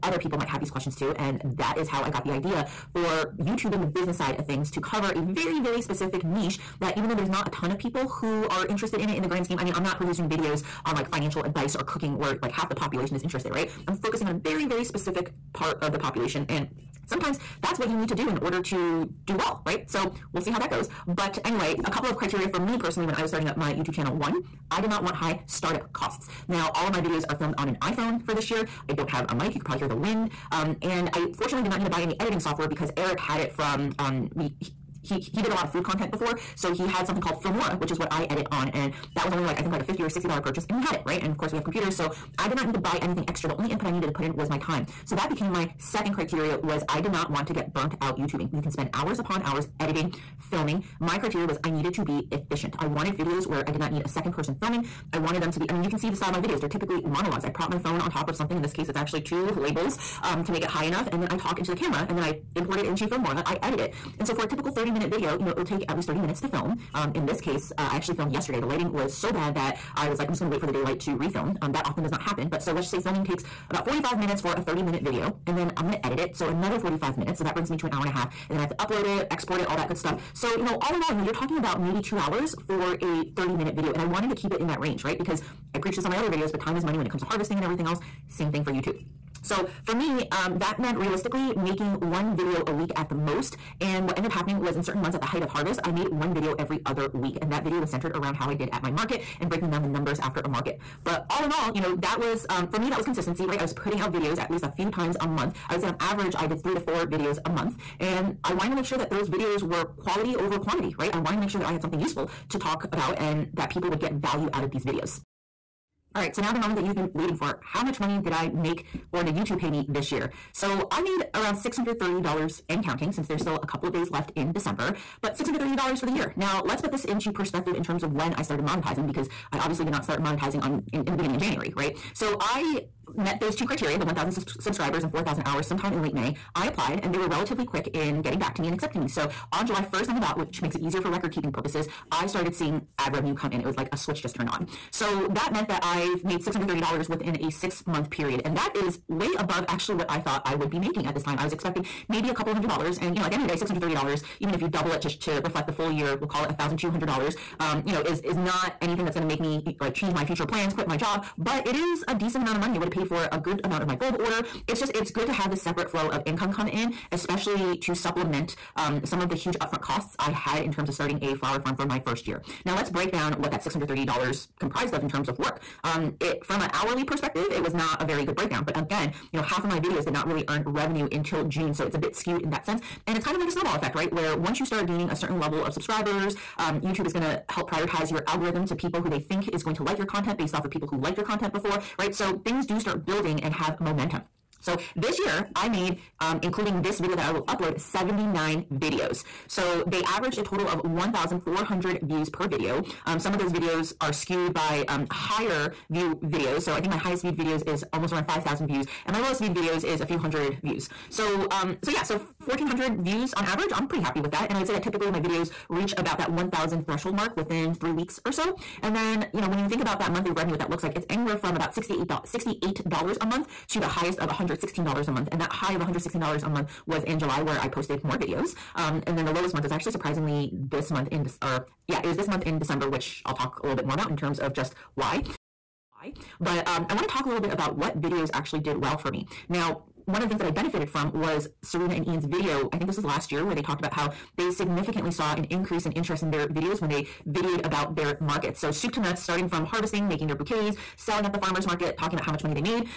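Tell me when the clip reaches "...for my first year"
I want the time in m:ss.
2:51.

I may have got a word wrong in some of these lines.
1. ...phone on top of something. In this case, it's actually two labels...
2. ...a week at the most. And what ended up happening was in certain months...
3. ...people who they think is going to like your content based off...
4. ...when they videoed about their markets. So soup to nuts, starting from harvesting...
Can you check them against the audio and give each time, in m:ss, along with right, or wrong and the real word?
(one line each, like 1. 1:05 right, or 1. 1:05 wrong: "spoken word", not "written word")
1. 0:57 right
2. 1:32 right
3. 3:08 right
4. 4:06 right.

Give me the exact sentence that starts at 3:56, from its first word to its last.
But um, I want to talk a little bit about what videos actually did well for me.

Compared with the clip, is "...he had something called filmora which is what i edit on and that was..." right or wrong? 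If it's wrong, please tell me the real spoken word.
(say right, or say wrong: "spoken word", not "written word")
right.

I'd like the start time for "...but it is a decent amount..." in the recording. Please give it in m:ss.
2:41.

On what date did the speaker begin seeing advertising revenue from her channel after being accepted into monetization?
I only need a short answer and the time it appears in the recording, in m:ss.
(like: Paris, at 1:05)
July 1st, at 2:19.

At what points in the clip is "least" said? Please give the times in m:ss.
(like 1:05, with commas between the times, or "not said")
1:05, 1:44.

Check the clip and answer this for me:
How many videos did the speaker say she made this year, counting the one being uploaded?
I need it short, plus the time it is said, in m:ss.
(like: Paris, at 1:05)
79, at 3:17.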